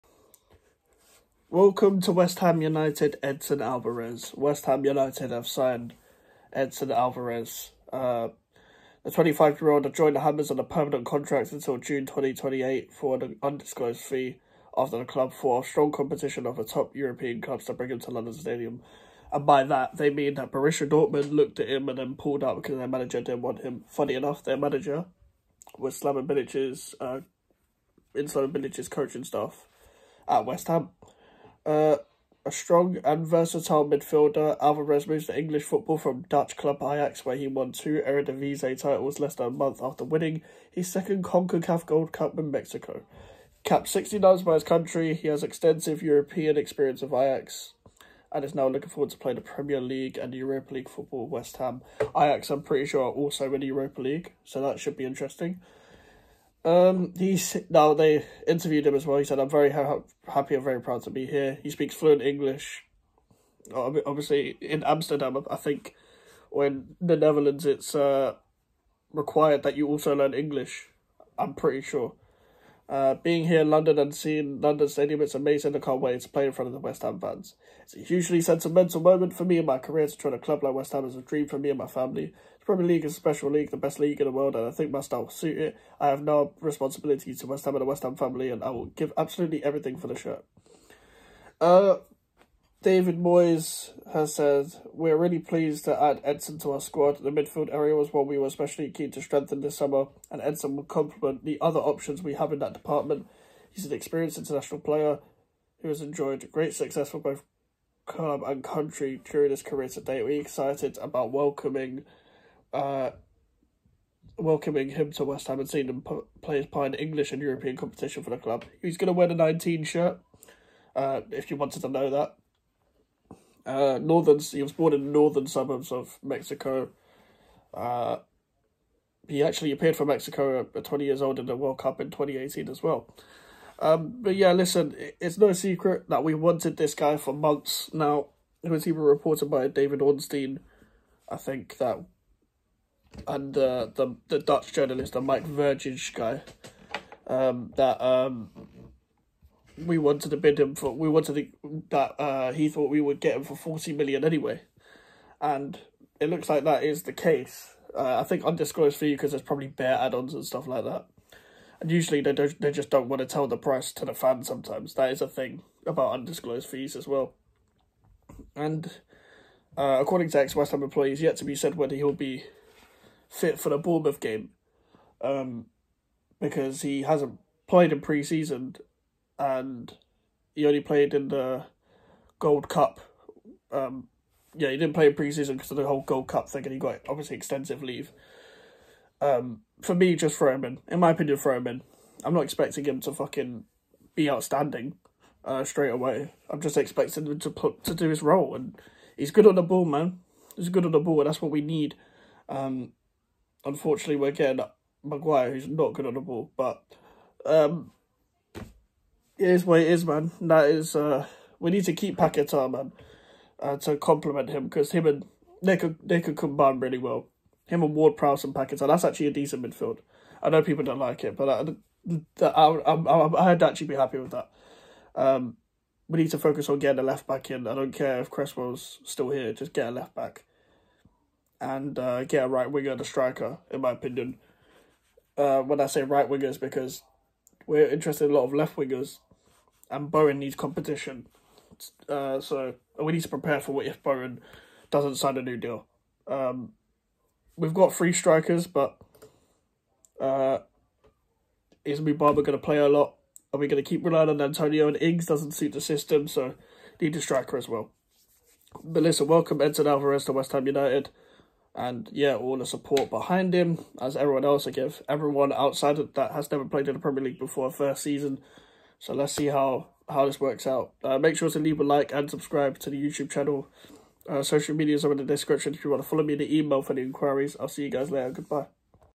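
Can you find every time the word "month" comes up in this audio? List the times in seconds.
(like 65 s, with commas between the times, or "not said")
39 s, 137 s.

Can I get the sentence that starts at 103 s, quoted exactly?
He's an experienced international player who has enjoyed great success for both club and country during his career to date.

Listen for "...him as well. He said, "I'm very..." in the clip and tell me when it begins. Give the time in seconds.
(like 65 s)
58 s.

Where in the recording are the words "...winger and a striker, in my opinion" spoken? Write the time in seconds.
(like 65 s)
232 s.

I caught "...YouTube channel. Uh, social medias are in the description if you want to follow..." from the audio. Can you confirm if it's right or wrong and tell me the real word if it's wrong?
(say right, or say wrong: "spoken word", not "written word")
right.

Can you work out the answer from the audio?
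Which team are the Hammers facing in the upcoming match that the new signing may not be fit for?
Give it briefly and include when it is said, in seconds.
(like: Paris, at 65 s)
Bournemouth, at 173 s.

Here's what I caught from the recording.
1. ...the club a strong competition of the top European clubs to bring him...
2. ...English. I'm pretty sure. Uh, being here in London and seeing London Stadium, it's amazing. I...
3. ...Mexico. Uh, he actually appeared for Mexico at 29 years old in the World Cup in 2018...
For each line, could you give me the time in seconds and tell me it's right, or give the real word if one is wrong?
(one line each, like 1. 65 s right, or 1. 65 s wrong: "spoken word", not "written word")
1. 14 s right
2. 70 s right
3. 126 s wrong: "20", not "29".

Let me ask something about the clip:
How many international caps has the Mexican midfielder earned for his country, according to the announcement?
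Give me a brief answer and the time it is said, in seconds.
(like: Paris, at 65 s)
60, at 43 s.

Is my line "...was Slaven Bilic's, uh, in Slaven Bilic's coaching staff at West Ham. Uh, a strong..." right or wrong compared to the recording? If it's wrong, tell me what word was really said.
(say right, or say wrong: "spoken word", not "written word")
right.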